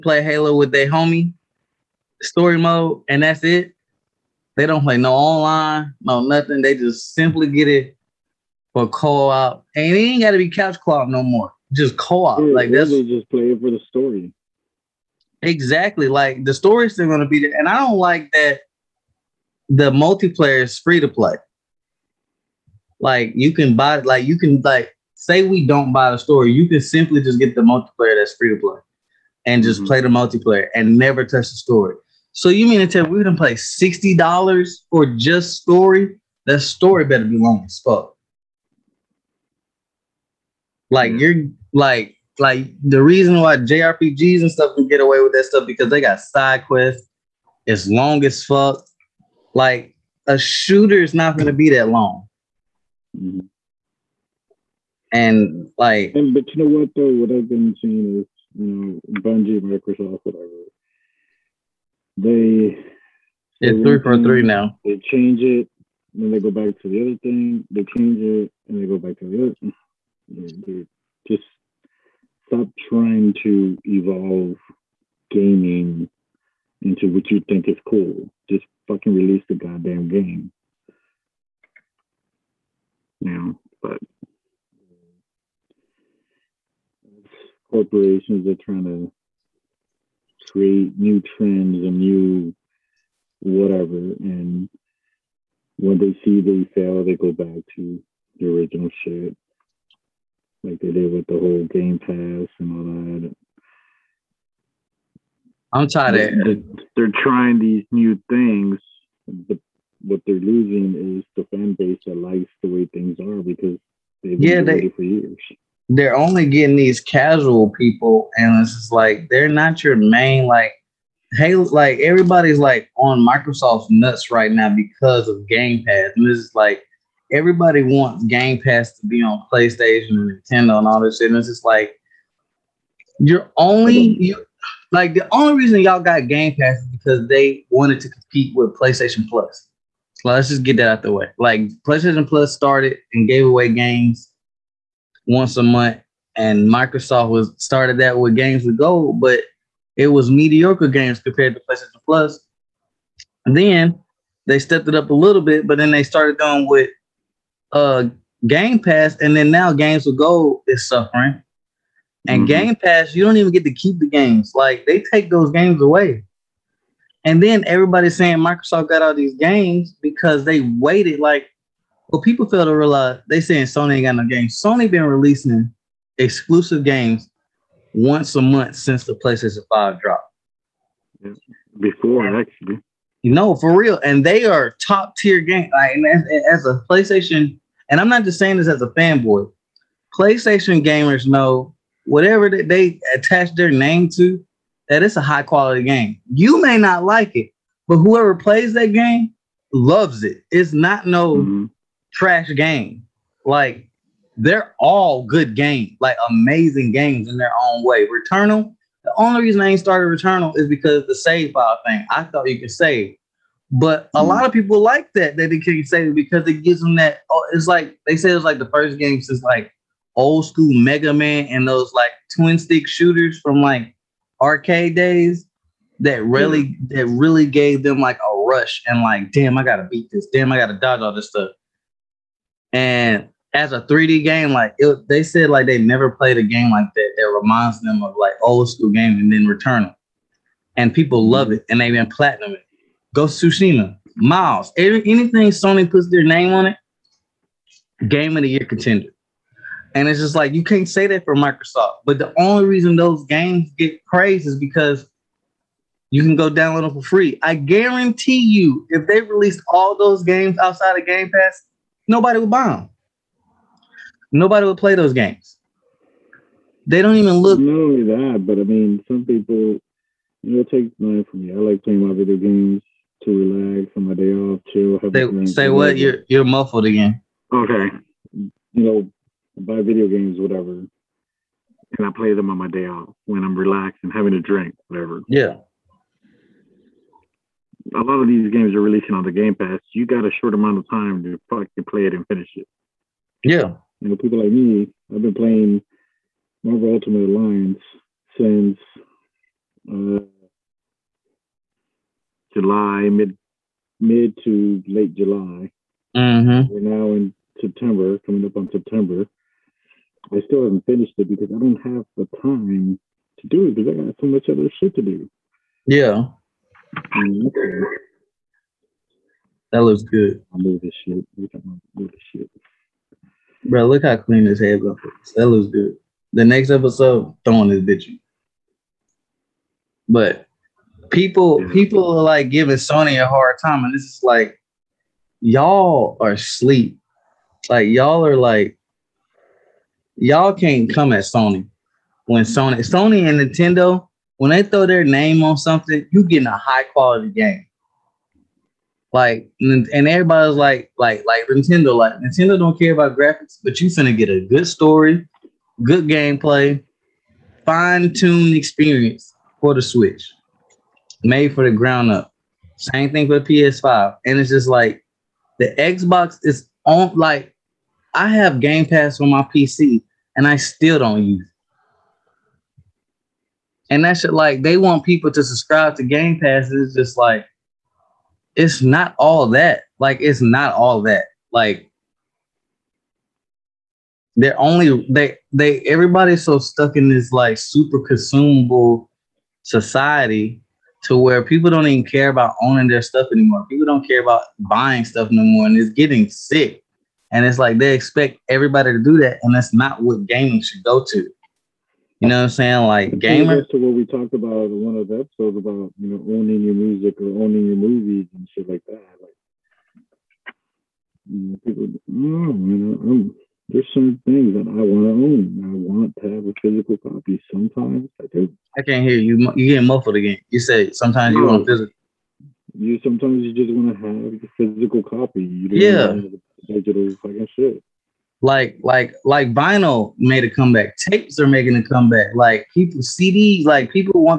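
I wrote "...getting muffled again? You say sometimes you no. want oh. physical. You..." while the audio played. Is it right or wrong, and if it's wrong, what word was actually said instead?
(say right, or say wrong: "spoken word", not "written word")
right.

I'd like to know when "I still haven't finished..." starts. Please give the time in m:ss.
5:10.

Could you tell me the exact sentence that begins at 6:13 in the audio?
And that shit like they want people to subscribe to Game Pass.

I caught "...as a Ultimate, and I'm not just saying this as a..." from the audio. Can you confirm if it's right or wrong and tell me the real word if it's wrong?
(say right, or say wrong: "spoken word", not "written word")
wrong: "PlayStation", not "Ultimate".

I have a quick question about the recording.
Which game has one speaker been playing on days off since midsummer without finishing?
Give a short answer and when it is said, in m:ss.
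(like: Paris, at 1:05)
Marvel Ultimate Alliance, at 4:56.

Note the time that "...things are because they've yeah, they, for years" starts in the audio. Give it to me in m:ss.
1:52.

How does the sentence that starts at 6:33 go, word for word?
People don't care about buying stuff no more, and it's getting sick.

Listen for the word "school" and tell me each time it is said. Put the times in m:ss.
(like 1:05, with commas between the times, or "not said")
3:40, 3:58.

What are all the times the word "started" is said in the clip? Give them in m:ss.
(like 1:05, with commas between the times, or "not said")
2:22, 2:27, 2:36, 3:29.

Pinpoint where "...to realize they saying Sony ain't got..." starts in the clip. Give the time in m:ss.
2:52.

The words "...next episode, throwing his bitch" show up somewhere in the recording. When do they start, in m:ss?
5:26.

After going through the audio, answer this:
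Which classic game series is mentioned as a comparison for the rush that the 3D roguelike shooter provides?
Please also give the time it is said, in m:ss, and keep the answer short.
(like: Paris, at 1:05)
Mega Man, at 3:40.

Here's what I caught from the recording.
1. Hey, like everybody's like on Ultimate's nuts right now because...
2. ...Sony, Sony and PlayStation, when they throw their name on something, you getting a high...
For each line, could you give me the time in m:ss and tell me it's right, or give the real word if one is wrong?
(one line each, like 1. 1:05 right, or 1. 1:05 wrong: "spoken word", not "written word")
1. 2:01 wrong: "Microsoft", not "Ultimate"
2. 5:42 wrong: "Nintendo", not "PlayStation".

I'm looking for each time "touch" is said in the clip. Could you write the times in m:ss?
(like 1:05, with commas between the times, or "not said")
0:31.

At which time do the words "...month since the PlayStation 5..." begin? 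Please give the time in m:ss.
2:58.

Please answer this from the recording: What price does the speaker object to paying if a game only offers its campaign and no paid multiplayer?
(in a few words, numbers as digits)
$60.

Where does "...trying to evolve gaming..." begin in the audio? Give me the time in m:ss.
1:12.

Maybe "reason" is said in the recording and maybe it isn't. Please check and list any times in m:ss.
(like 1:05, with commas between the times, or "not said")
0:43, 2:15, 3:29, 4:12.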